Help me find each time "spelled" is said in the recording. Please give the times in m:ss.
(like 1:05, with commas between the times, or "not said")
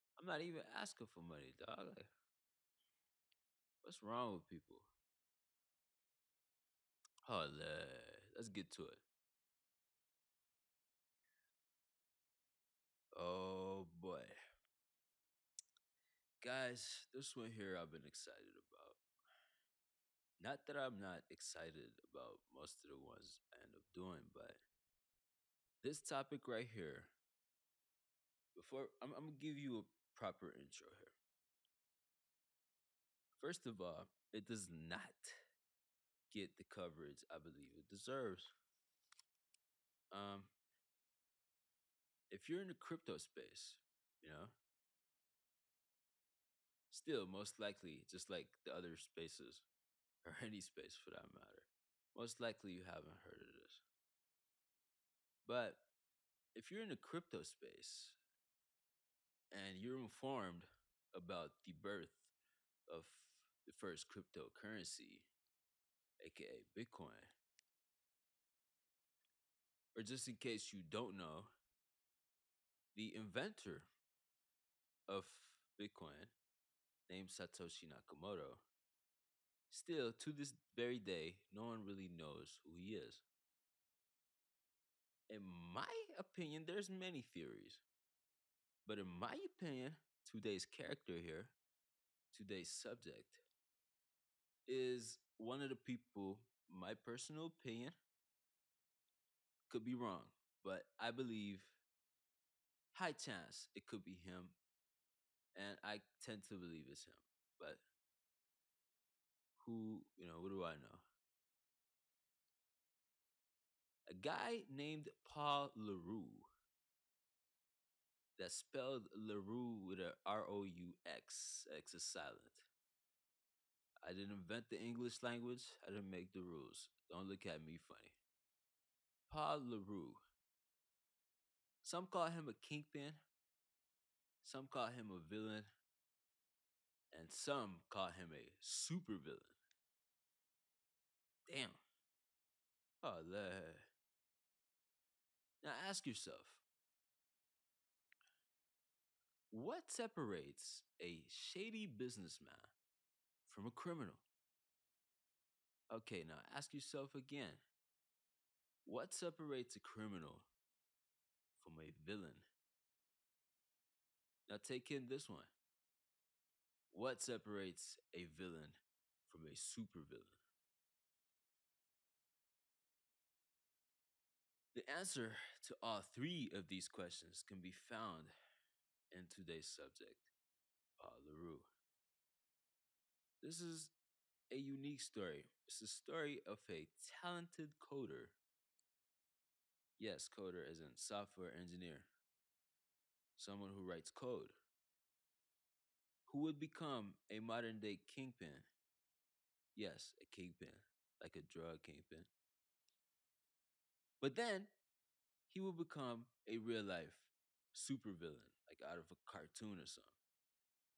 1:58.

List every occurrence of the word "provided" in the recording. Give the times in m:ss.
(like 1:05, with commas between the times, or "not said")
not said.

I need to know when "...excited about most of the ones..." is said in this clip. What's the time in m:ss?
0:21.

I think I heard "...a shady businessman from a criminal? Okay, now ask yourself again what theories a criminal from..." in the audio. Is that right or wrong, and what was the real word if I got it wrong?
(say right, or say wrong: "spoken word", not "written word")
wrong: "separates", not "theories".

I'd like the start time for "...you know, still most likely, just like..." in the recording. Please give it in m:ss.
0:44.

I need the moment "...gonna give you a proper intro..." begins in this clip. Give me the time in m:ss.
0:29.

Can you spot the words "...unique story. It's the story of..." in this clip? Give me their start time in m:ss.
3:04.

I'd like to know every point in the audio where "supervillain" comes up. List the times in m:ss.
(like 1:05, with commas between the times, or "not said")
2:18, 2:49, 3:27.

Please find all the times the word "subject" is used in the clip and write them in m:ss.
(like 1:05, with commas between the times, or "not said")
1:32, 2:59.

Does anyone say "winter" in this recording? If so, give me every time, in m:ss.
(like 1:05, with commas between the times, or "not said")
not said.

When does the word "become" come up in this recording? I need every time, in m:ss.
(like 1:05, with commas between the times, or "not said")
3:16, 3:25.